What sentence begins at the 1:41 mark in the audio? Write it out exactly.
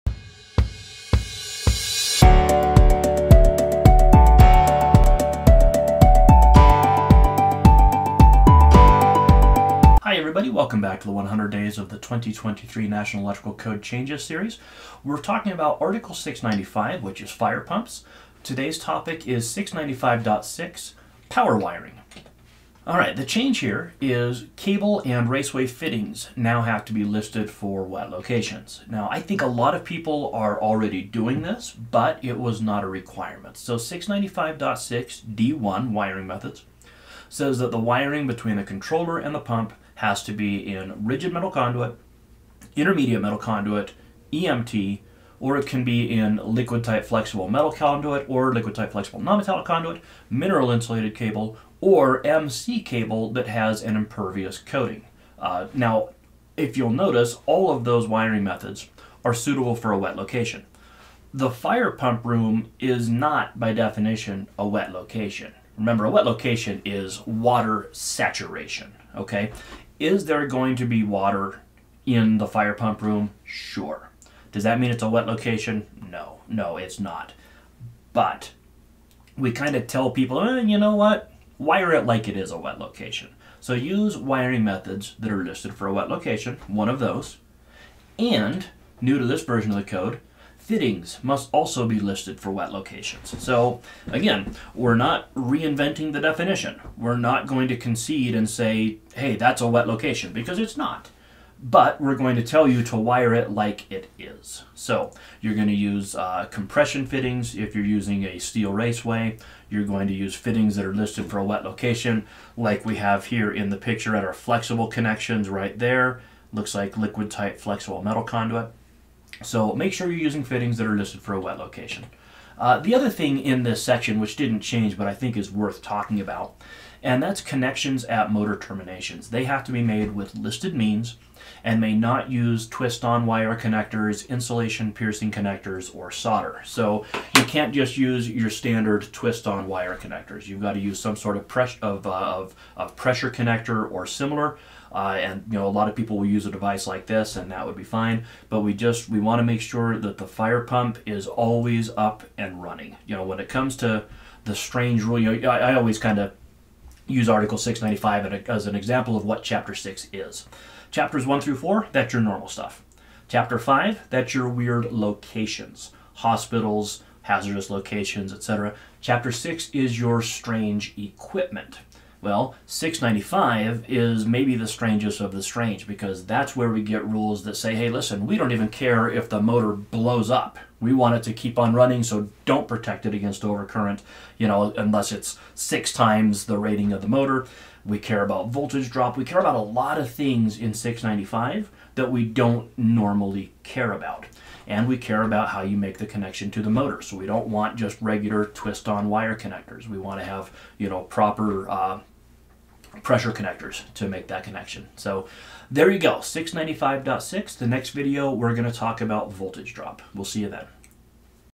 But we're going to tell you to wire it like it is.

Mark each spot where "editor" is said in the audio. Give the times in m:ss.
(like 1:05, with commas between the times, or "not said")
not said.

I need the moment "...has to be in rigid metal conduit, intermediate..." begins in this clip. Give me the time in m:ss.
0:40.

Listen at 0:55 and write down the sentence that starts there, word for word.
Uh, now, if you'll notice, all of those wiring methods are suitable for a wet location.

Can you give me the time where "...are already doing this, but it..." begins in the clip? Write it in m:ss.
0:30.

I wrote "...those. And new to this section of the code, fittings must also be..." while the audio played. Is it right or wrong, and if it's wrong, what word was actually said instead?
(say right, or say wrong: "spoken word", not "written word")
wrong: "version", not "section".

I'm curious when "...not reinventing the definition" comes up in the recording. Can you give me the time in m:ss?
1:34.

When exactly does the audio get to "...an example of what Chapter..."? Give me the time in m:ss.
2:38.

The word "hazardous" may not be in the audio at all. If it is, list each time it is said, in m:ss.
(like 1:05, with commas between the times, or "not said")
2:47.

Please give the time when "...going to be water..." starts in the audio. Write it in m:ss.
1:10.